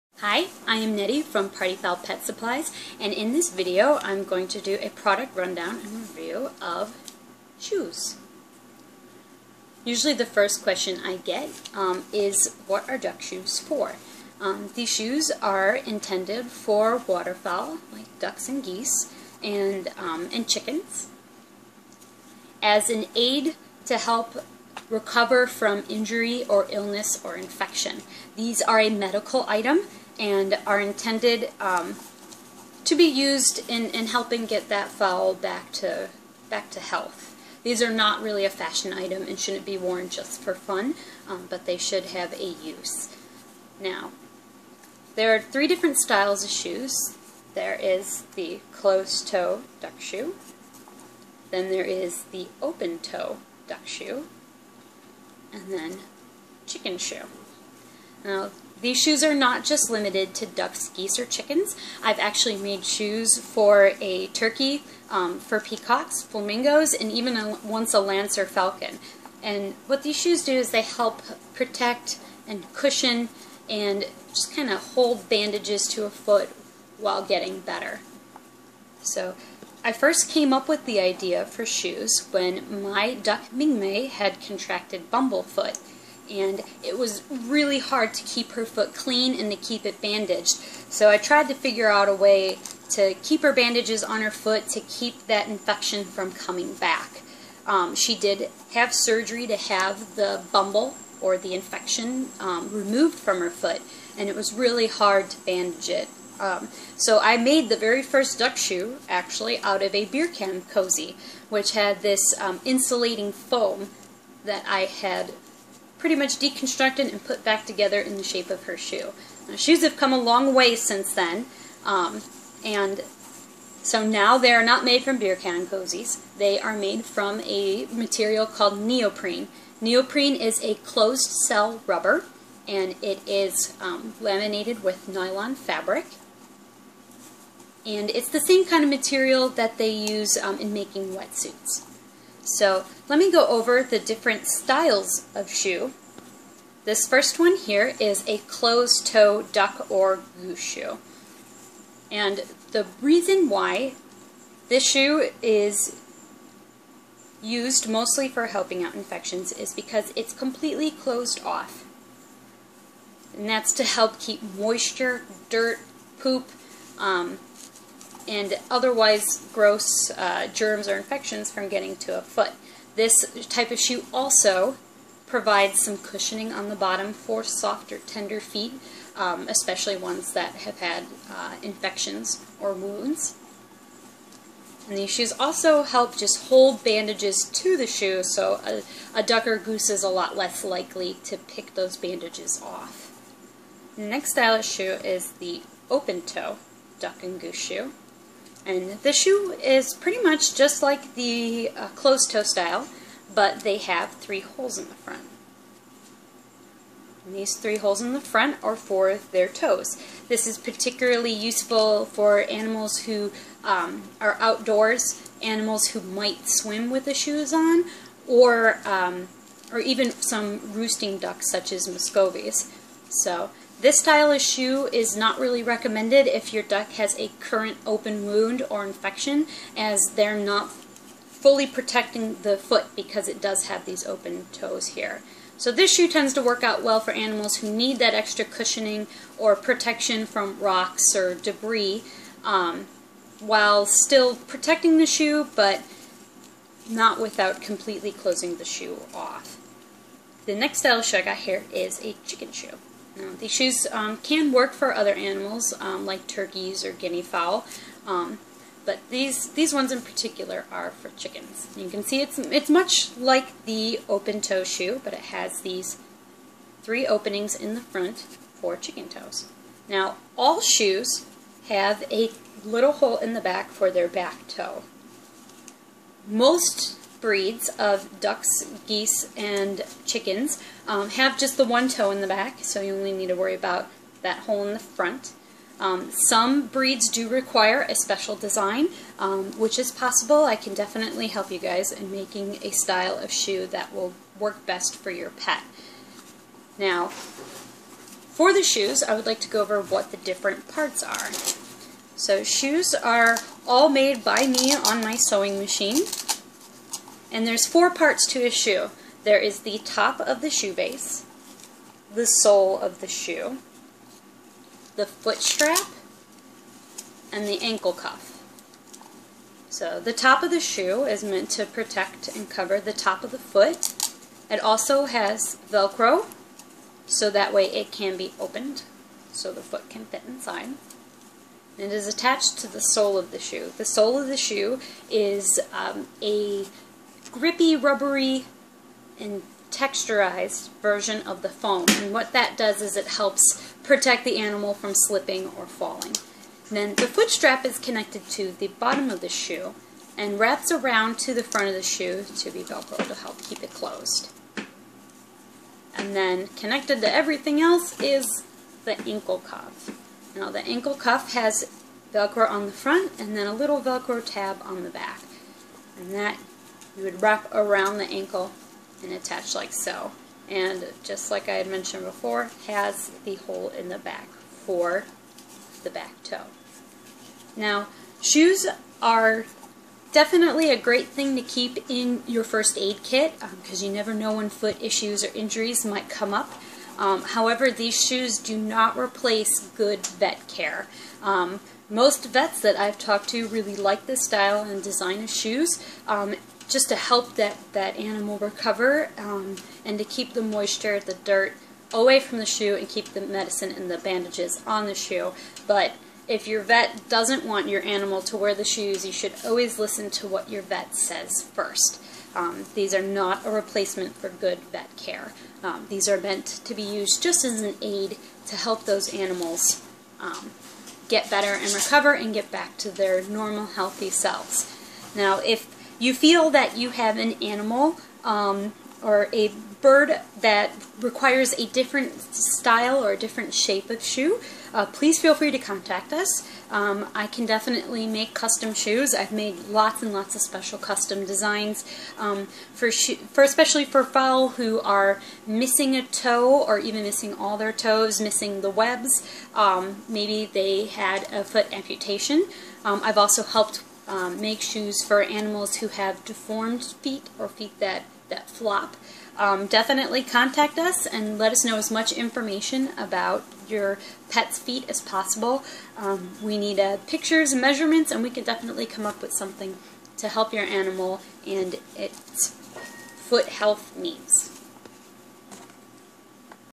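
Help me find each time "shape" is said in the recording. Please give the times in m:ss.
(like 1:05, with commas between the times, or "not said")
1:58, 7:13.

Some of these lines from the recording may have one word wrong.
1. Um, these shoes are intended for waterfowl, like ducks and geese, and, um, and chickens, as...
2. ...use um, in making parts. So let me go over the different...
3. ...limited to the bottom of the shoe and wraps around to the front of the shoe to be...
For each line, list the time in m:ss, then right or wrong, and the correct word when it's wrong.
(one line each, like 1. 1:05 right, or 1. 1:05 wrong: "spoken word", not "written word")
1. 0:14 right
2. 2:19 wrong: "wetsuits", not "parts"
3. 5:47 wrong: "connected", not "limited".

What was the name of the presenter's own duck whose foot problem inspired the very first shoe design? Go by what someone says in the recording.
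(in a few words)
Ming Mei.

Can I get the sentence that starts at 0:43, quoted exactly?
Now, there are three different styles of shoes.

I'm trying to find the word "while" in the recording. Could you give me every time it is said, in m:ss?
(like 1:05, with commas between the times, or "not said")
1:16, 4:03.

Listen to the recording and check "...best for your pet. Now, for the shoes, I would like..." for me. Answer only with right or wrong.
right.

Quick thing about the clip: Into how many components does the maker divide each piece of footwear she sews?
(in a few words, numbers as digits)
4.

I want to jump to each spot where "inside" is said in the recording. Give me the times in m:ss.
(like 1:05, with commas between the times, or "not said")
5:30.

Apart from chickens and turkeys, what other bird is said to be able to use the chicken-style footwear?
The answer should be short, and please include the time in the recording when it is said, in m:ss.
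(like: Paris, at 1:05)
guinea fowl, at 4:16.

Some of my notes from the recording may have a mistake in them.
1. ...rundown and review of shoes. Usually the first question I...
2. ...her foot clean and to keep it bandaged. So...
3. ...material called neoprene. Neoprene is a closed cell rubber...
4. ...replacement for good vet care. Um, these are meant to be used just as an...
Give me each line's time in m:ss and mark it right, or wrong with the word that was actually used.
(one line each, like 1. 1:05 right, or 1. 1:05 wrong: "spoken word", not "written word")
1. 0:05 right
2. 1:28 right
3. 2:07 right
4. 6:53 right.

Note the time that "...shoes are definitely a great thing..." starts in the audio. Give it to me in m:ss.
6:18.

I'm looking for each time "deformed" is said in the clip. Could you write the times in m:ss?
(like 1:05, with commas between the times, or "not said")
7:36.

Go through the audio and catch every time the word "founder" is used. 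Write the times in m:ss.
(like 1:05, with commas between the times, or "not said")
not said.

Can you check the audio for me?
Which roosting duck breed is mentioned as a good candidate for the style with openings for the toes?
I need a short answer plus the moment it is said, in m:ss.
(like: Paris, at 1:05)
Muscovies, at 3:41.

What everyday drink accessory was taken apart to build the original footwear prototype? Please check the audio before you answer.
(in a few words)
beer can cozy.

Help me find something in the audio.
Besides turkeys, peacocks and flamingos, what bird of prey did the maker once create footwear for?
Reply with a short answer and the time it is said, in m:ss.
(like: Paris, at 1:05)
lanner falcon, at 1:07.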